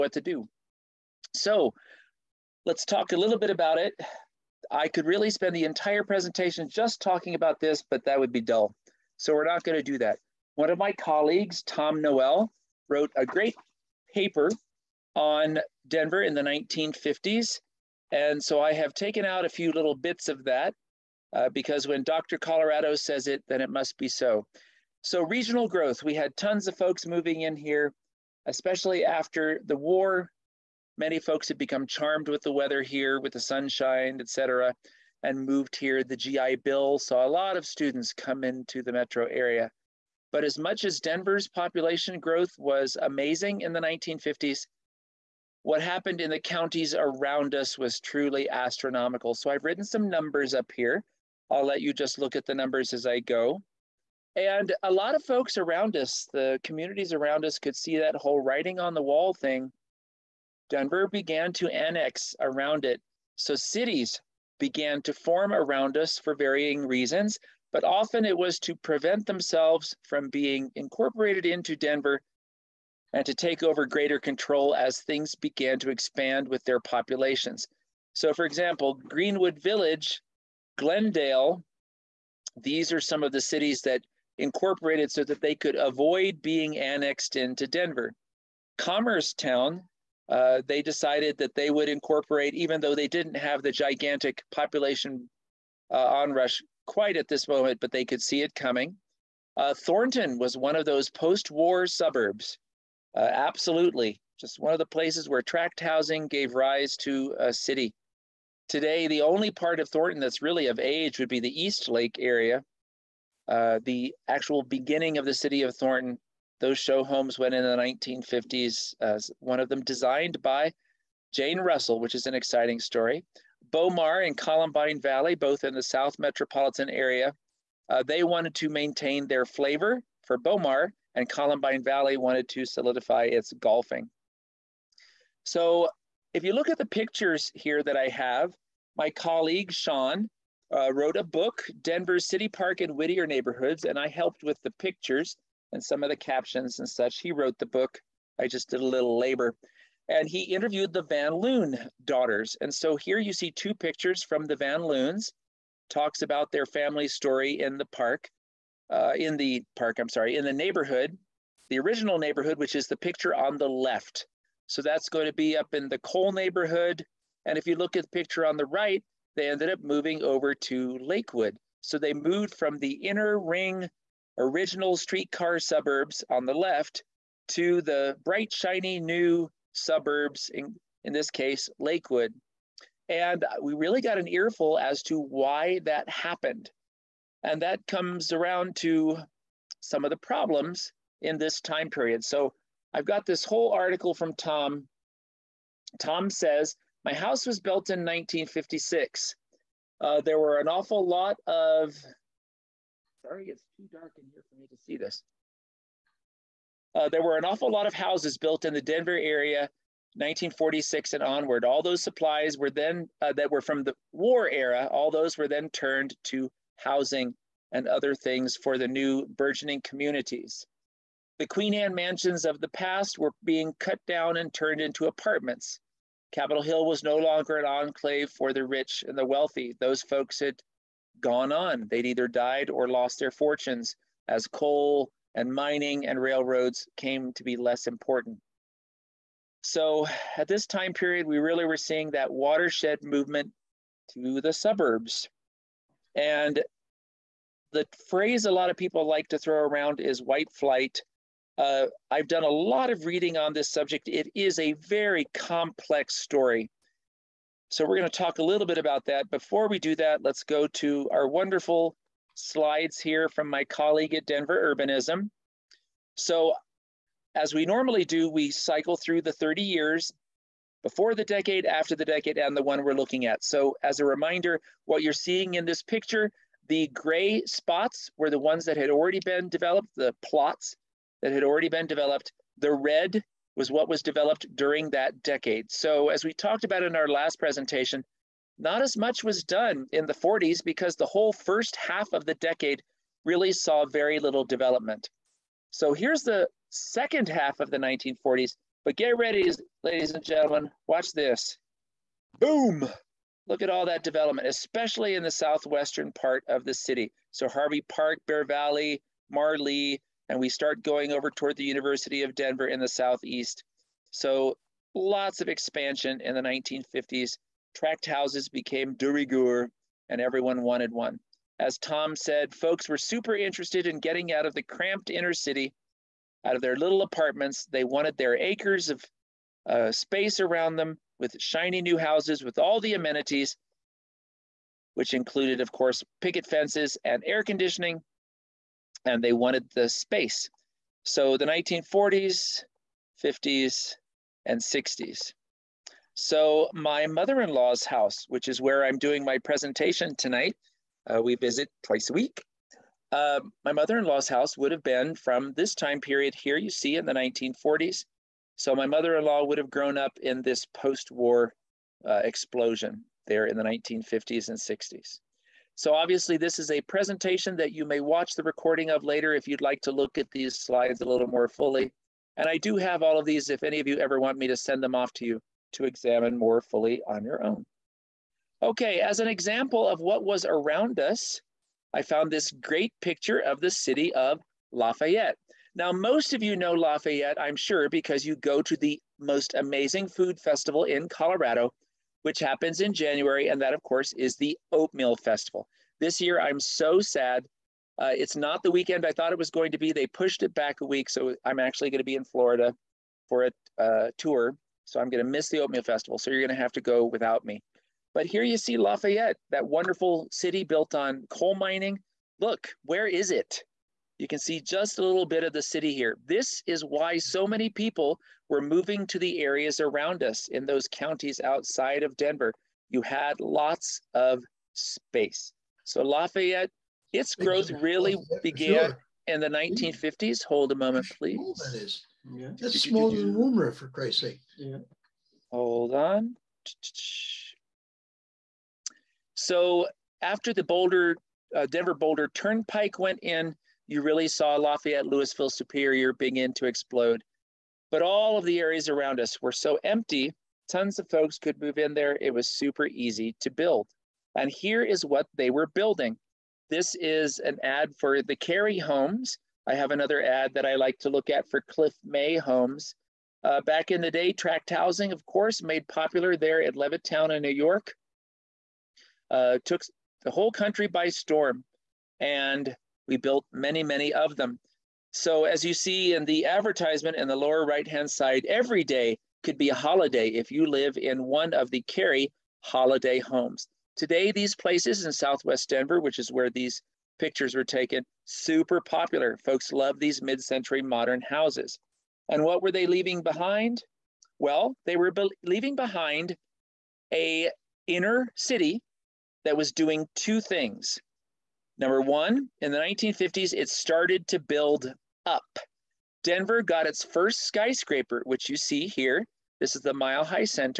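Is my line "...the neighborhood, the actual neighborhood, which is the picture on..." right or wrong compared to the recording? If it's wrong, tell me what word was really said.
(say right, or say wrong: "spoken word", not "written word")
wrong: "original", not "actual".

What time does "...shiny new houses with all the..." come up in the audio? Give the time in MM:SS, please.
05:31.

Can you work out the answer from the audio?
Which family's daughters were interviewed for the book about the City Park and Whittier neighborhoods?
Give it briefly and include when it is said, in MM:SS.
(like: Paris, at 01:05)
Van Loon, at 02:31.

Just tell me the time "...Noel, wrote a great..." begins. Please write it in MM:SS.
00:12.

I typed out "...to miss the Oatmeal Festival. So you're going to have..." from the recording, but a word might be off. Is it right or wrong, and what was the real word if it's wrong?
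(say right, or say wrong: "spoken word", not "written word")
right.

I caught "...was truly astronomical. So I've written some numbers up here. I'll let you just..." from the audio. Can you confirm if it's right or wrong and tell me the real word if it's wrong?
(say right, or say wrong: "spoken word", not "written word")
right.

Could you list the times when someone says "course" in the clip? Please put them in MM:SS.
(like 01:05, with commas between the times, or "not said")
05:35, 06:33, 07:45.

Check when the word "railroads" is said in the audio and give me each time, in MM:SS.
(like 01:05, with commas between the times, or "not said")
03:56.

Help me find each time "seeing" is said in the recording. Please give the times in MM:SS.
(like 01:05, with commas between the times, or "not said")
04:01, 04:35.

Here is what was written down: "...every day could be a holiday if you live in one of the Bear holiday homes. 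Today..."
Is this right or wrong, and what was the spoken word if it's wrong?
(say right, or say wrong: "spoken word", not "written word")
wrong: "Cary", not "Bear".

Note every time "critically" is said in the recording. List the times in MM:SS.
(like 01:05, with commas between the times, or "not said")
not said.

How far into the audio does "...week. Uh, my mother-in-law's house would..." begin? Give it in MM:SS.
05:52.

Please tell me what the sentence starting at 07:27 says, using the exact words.
But all of the areas around us were so empty, tons of folks could move in there.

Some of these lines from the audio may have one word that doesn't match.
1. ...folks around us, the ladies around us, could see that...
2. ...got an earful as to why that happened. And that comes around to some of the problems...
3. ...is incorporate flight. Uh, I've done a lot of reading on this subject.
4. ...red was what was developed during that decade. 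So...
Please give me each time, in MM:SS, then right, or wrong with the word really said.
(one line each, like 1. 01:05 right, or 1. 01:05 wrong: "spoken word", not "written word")
1. 00:55 wrong: "communities", not "ladies"
2. 03:03 right
3. 04:09 wrong: "white", not "incorporate"
4. 04:42 right.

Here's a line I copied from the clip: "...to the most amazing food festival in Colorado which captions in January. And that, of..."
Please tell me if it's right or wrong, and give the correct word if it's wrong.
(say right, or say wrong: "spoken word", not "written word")
wrong: "happens", not "captions".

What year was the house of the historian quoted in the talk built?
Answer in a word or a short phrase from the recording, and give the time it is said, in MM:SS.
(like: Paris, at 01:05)
1956, at 03:17.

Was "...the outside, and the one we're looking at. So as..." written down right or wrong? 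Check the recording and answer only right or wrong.
wrong.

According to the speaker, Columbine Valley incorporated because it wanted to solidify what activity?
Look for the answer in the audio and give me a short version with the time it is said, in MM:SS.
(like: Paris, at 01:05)
golfing, at 02:13.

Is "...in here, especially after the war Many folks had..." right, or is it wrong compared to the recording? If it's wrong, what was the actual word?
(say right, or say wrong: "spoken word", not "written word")
right.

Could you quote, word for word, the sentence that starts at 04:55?
So, here's the second half of the 1940s.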